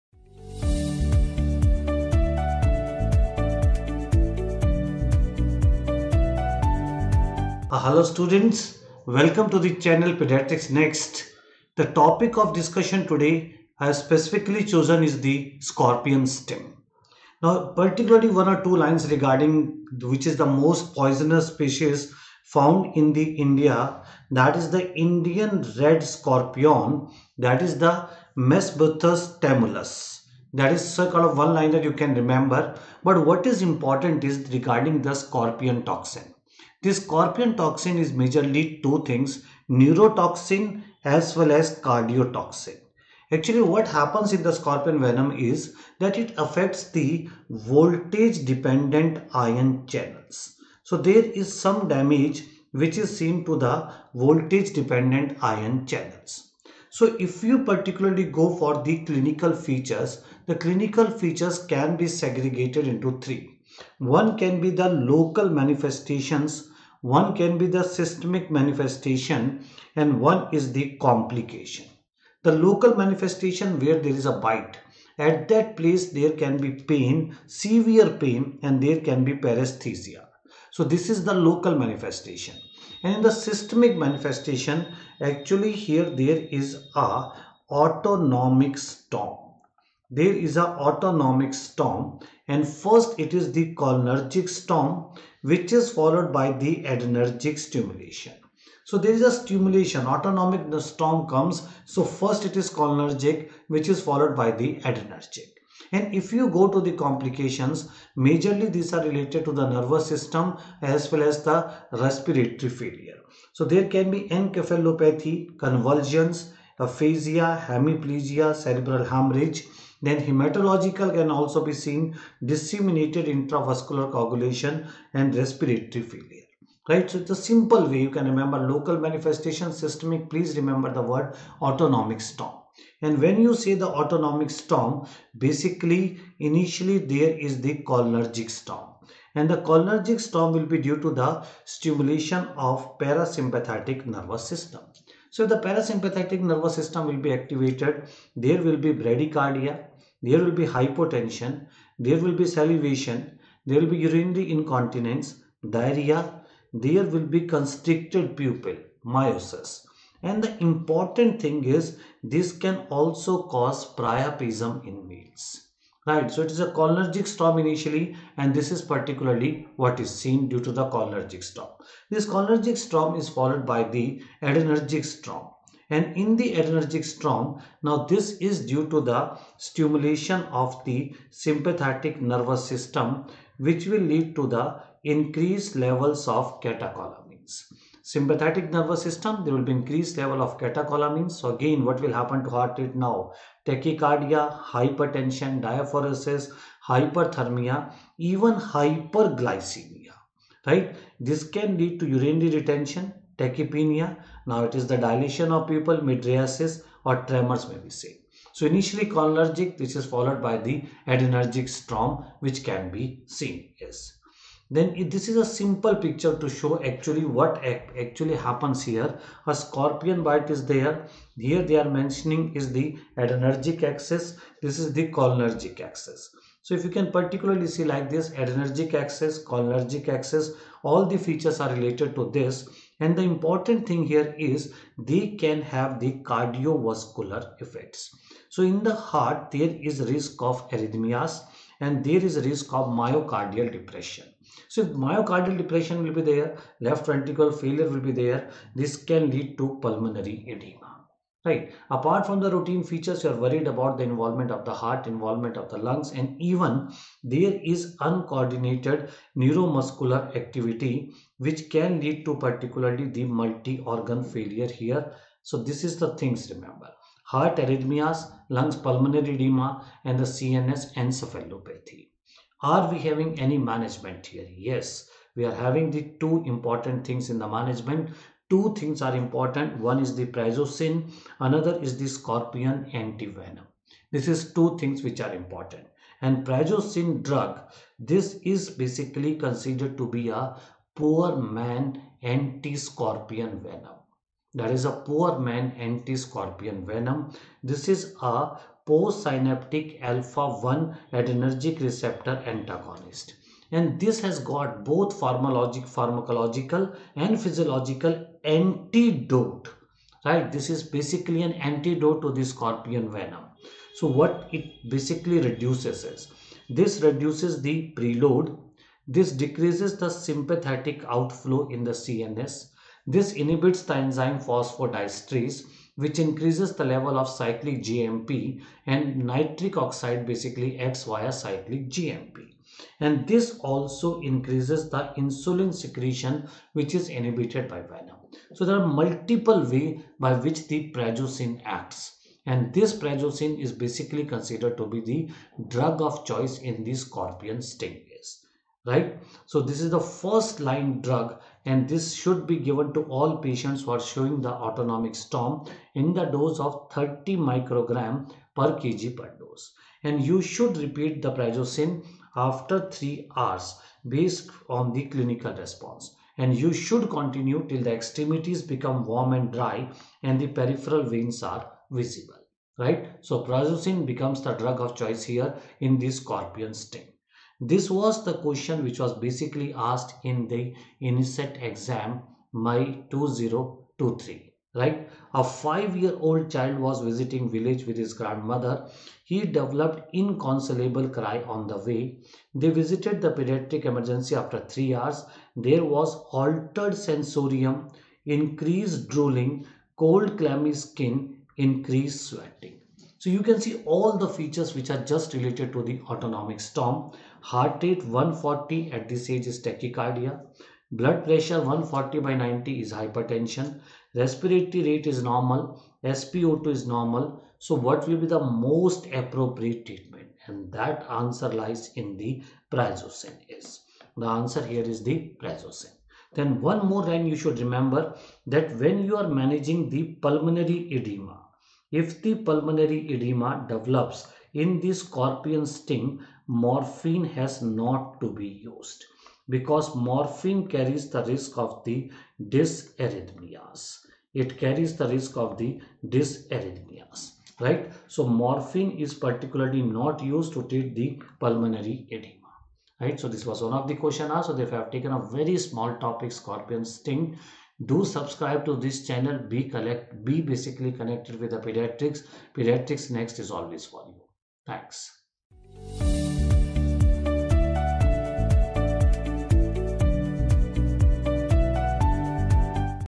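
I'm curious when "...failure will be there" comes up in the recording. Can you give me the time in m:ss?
4:07.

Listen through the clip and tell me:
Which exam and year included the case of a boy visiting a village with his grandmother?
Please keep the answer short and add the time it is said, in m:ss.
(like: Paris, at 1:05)
INI-CET 2023, at 6:20.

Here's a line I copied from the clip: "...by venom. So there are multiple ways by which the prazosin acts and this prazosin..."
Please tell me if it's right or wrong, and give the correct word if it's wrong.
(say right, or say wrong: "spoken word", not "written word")
right.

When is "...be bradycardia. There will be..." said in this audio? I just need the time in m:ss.
2:28.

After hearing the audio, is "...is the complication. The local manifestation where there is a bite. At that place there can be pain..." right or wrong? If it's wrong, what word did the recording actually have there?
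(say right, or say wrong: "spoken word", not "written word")
right.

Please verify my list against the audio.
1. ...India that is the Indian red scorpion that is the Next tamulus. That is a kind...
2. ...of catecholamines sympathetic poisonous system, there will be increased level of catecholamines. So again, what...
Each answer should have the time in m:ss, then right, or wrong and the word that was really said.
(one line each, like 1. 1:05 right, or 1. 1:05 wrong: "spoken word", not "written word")
1. 0:23 wrong: "Mesobuthus", not "Next"
2. 3:06 wrong: "nervous", not "poisonous".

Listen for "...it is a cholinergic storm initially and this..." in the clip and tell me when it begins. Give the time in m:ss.
2:46.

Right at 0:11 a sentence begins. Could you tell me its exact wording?
The topic of discussion today I have specifically chosen is the scorpion sting.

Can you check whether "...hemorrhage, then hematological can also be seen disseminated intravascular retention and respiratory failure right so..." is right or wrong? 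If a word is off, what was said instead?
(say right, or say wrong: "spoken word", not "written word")
wrong: "coagulation", not "retention".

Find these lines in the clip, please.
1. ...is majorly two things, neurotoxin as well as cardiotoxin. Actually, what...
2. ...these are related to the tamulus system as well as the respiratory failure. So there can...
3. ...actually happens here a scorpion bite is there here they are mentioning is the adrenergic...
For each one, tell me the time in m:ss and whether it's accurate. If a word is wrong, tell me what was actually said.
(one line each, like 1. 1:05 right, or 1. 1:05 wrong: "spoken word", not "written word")
1. 0:37 right
2. 1:48 wrong: "nervous", not "tamulus"
3. 3:37 right.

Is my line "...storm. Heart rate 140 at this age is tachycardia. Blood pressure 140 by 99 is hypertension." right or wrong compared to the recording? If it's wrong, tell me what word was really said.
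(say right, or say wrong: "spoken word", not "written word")
wrong: "90", not "99".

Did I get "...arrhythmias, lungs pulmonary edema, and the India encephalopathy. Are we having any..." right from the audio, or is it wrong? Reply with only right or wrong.
wrong.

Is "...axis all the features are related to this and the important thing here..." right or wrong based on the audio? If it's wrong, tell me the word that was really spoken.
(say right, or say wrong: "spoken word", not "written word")
right.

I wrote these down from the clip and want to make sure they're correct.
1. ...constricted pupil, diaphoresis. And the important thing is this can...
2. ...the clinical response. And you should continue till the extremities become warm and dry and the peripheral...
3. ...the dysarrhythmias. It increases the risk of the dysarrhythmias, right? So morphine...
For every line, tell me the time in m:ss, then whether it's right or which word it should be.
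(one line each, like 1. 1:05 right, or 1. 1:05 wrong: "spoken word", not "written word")
1. 2:37 wrong: "miosis", not "diaphoresis"
2. 6:04 right
3. 7:21 wrong: "carries", not "increases".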